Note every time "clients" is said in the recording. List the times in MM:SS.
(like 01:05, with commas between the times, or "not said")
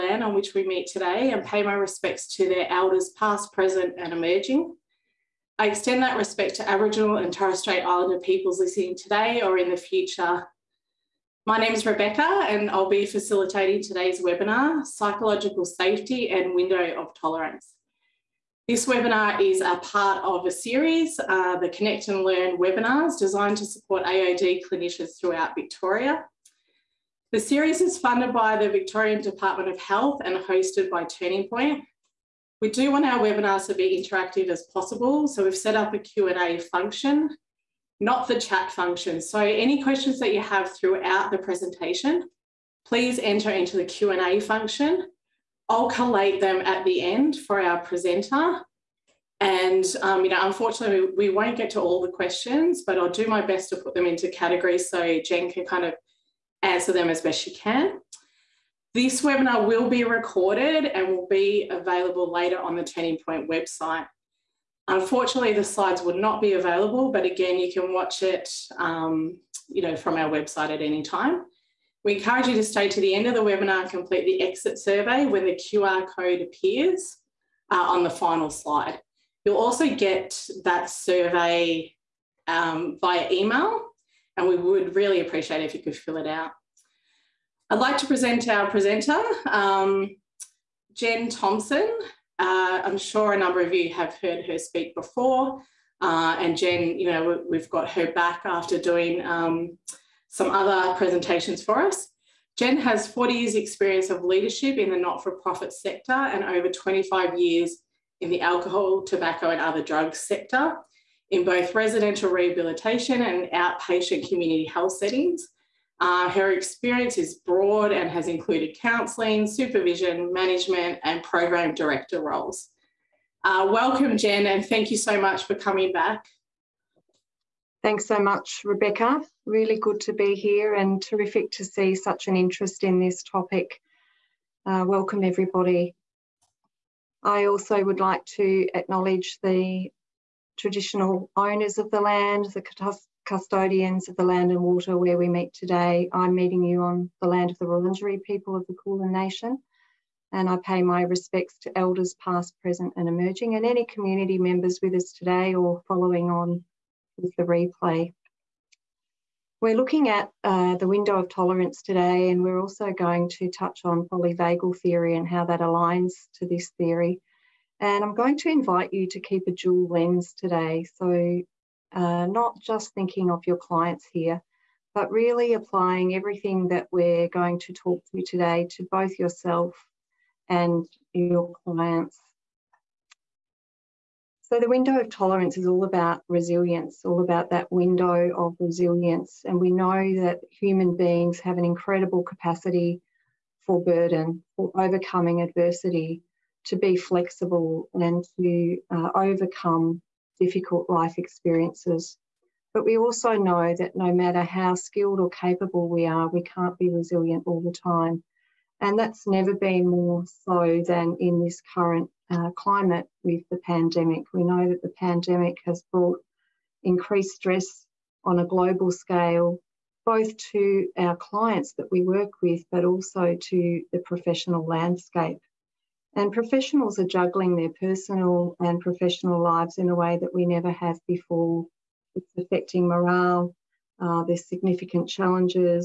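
02:53, 03:01, 03:41.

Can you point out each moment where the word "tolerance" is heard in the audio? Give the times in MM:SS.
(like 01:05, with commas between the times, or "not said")
00:17, 02:41, 03:05.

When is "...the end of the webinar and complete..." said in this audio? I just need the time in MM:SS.
01:13.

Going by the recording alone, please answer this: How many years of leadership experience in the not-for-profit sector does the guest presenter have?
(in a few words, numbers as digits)
40.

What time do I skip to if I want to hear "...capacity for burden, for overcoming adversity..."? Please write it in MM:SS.
03:12.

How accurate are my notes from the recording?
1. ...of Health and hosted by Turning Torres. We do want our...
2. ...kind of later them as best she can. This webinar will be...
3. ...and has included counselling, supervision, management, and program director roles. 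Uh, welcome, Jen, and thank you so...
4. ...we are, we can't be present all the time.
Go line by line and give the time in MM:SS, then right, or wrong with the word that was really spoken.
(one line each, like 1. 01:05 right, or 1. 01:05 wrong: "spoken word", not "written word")
1. 00:29 wrong: "Point", not "Torres"
2. 00:55 wrong: "answer", not "later"
3. 01:57 right
4. 03:25 wrong: "resilient", not "present".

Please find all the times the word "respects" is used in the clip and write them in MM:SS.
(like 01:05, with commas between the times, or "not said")
00:01, 00:06, 02:31.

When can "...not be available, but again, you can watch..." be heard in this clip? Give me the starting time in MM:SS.
01:06.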